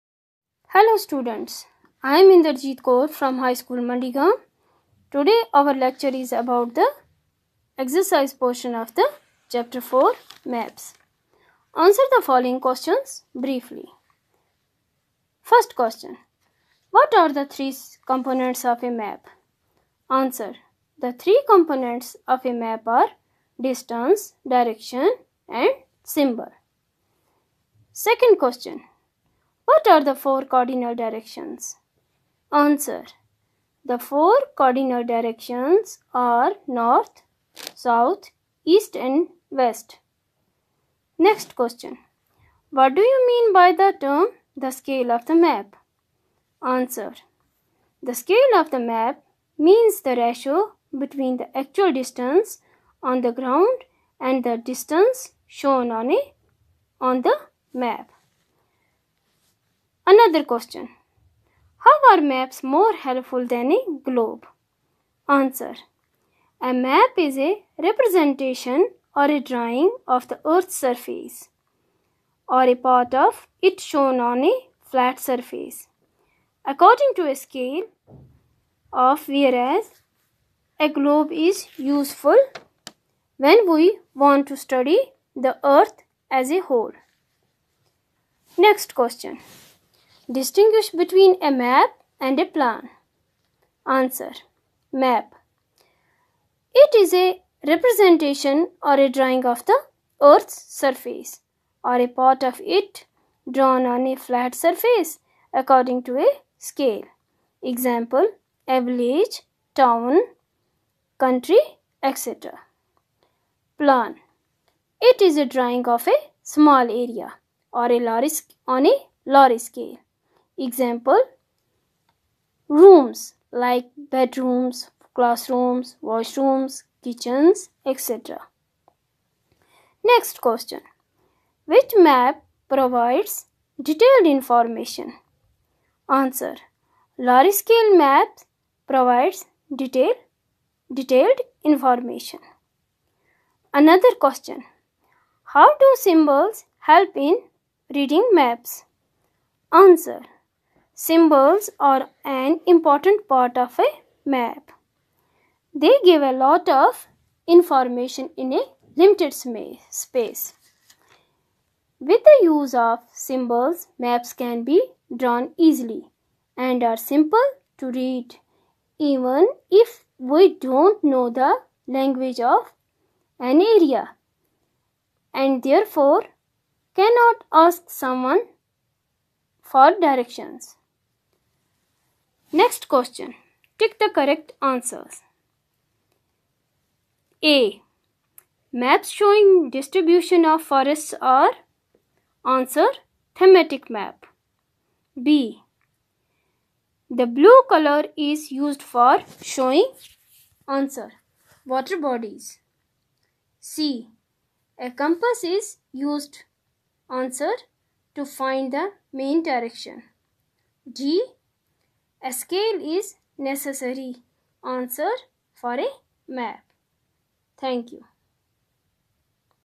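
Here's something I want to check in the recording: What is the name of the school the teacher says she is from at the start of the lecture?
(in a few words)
High School Mandigam.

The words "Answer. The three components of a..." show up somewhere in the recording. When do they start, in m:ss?
0:20.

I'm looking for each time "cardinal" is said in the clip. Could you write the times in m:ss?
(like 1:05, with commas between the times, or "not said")
0:30, 0:34.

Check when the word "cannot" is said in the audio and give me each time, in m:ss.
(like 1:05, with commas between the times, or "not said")
2:56.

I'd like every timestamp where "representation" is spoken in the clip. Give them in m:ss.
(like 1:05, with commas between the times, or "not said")
1:07, 1:37.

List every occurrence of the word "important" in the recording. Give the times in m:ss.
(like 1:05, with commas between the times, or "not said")
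2:32.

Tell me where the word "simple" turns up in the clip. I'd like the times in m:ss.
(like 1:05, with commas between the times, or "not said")
2:46.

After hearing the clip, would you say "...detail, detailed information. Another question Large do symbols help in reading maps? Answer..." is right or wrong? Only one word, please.
wrong.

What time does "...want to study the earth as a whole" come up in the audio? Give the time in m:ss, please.
1:24.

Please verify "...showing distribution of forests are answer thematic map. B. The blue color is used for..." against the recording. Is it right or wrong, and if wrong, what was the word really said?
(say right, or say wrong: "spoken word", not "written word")
right.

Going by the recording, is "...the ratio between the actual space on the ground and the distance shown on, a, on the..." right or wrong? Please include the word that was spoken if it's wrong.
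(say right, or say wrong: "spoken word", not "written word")
wrong: "distance", not "space".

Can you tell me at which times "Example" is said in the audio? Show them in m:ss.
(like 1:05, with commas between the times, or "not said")
1:47, 2:00.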